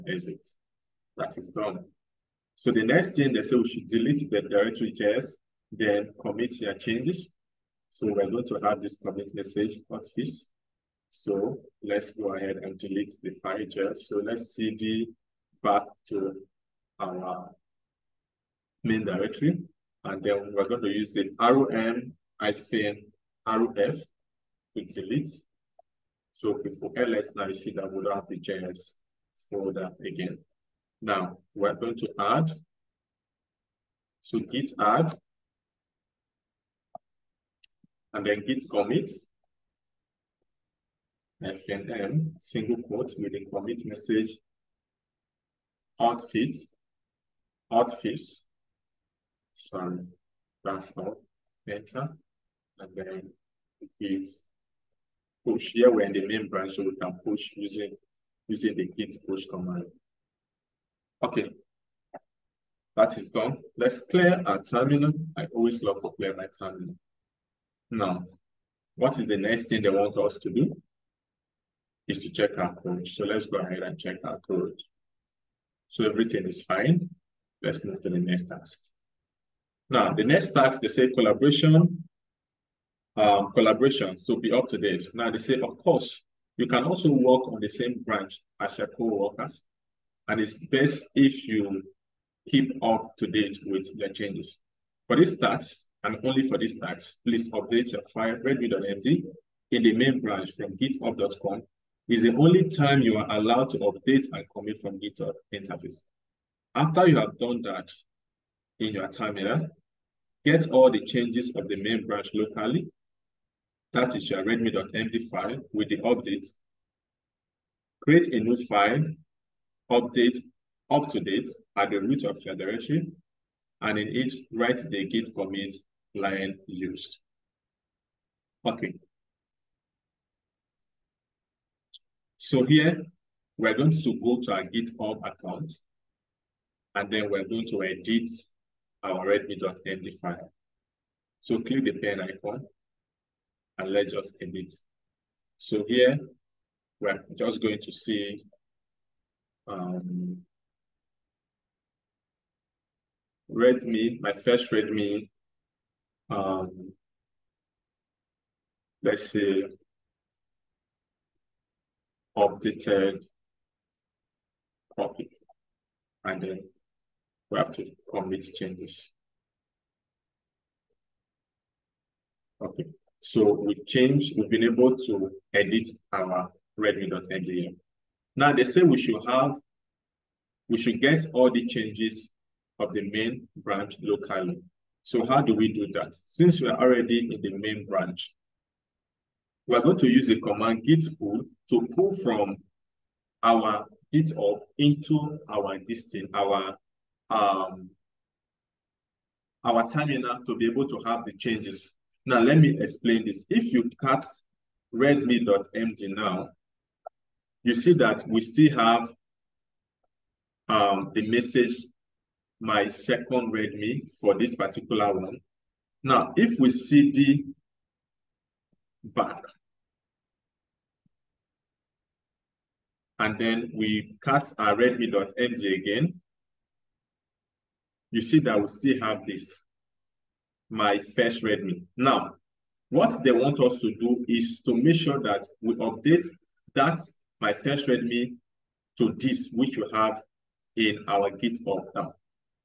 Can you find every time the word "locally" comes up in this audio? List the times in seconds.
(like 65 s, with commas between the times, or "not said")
112 s, 184 s.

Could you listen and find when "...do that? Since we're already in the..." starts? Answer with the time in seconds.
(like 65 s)
185 s.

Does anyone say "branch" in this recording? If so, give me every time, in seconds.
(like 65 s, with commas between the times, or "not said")
56 s, 88 s, 100 s, 112 s, 183 s, 187 s.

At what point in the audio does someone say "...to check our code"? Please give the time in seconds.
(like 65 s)
72 s.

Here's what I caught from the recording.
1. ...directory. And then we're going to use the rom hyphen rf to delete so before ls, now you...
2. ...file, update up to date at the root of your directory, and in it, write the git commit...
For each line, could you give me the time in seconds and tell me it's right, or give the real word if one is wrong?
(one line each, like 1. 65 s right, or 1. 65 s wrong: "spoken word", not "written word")
1. 19 s right
2. 118 s right.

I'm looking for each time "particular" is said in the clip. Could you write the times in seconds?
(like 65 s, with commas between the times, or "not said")
214 s.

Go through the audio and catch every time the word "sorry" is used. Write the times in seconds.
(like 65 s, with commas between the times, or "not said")
49 s.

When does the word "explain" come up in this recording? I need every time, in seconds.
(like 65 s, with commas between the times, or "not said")
202 s.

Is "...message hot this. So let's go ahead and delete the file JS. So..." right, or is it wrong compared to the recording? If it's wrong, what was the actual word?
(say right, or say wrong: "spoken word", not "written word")
right.